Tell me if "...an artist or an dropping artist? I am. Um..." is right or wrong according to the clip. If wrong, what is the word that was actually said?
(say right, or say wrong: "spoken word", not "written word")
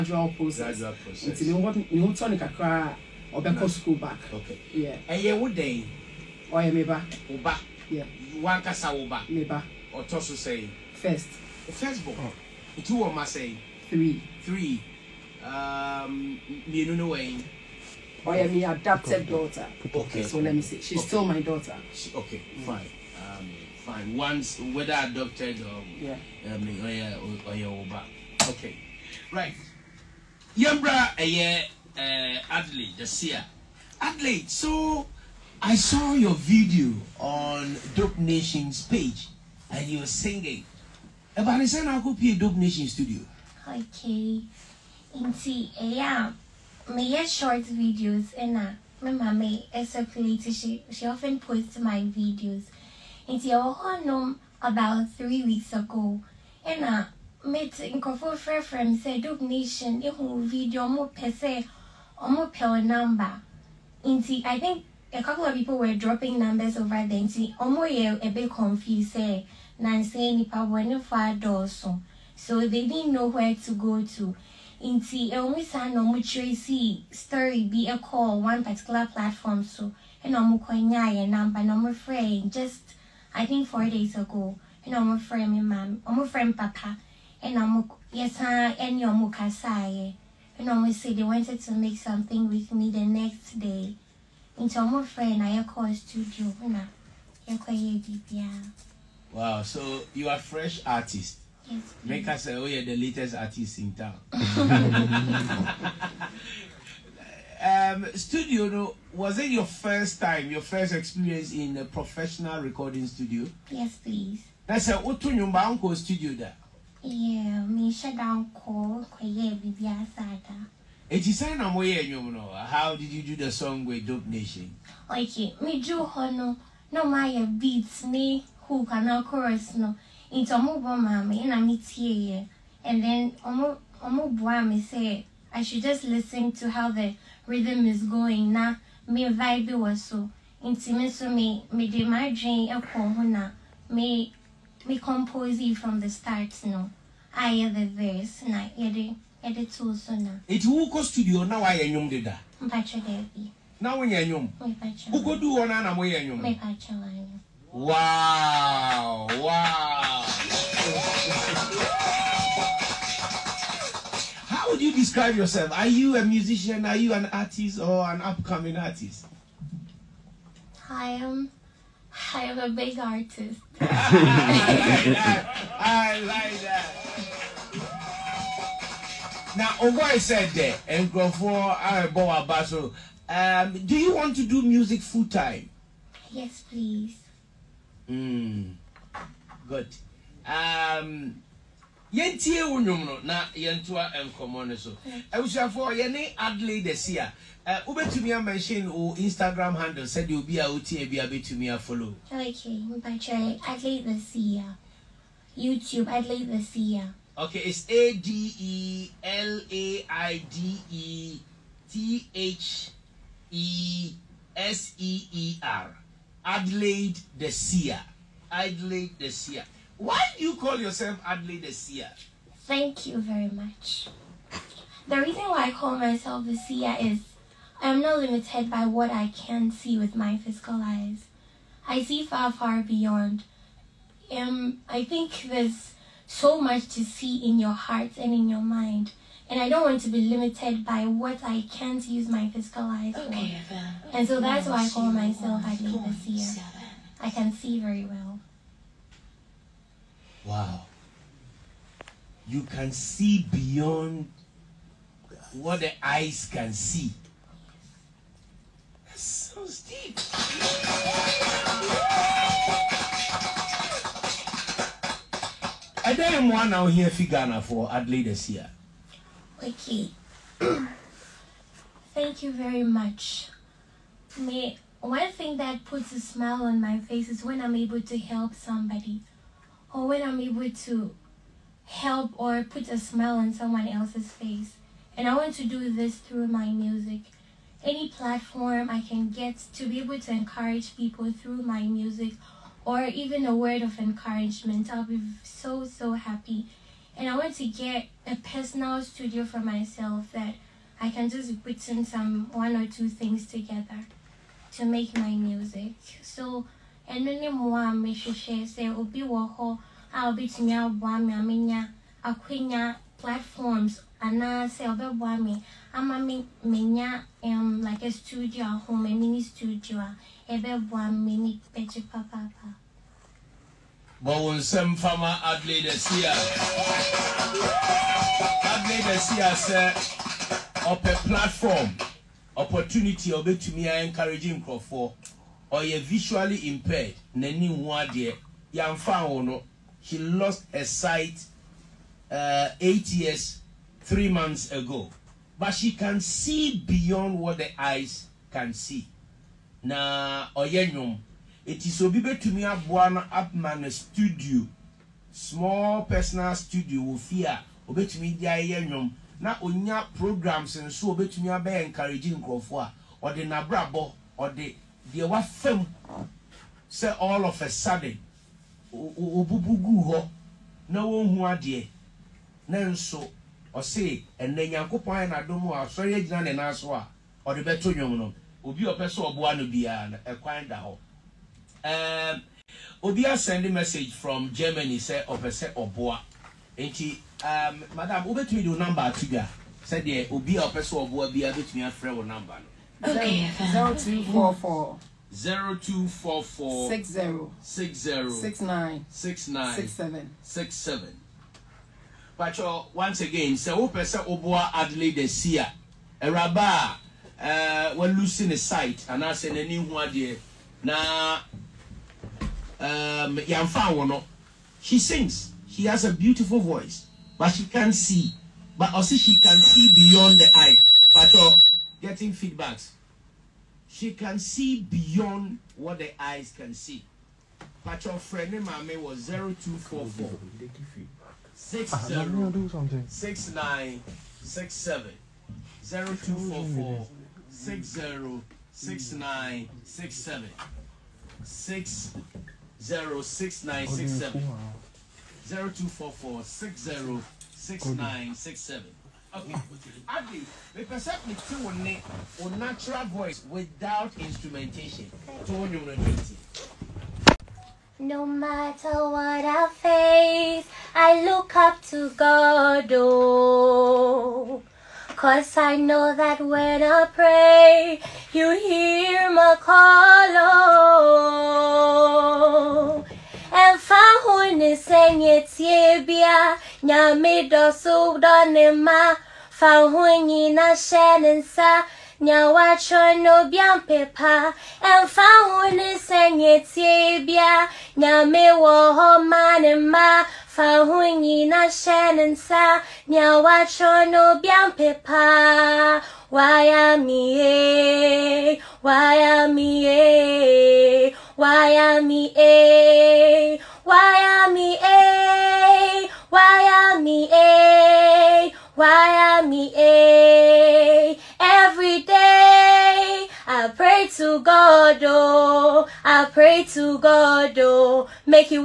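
wrong: "upcoming", not "dropping".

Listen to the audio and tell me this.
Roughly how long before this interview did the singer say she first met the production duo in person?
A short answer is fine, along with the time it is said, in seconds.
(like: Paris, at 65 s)
about 3 weeks ago, at 54 s.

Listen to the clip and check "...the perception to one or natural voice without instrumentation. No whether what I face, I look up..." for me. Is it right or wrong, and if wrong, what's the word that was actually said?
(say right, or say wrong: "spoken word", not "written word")
wrong: "matter", not "whether".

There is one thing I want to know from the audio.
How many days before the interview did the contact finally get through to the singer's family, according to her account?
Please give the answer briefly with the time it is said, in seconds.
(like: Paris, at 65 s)
4 days ago, at 83 s.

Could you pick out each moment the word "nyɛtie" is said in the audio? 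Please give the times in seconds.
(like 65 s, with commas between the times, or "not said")
475 s, 486 s.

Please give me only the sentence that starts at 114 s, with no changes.
That's a Otu Nyumba Uncle studio there.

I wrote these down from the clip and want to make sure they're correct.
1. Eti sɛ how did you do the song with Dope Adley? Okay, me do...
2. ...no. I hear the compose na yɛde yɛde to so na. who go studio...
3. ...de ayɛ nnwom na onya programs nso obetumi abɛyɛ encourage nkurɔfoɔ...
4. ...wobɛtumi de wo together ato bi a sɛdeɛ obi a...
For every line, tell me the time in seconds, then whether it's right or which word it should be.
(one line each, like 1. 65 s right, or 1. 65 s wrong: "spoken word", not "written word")
1. 121 s wrong: "Nation", not "Adley"
2. 146 s wrong: "verse", not "compose"
3. 358 s right
4. 388 s wrong: "number", not "together".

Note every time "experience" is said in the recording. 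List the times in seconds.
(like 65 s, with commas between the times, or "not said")
110 s.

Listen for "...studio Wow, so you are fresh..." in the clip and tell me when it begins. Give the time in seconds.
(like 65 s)
95 s.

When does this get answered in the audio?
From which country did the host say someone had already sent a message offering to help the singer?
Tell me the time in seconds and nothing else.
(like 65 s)
384 s.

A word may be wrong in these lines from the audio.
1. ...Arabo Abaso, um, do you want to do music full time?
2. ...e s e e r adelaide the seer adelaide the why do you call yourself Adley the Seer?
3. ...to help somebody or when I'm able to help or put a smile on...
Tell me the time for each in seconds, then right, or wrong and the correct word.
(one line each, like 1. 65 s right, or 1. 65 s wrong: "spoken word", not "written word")
1. 181 s right
2. 213 s right
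3. 278 s right.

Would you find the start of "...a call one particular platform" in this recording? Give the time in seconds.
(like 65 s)
77 s.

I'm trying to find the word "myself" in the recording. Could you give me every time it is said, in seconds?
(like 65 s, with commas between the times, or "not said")
225 s, 245 s, 299 s.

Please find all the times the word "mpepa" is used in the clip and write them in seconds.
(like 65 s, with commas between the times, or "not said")
483 s, 494 s.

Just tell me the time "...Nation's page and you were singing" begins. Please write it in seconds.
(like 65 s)
38 s.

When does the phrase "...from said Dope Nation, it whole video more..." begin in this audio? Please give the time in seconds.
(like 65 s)
58 s.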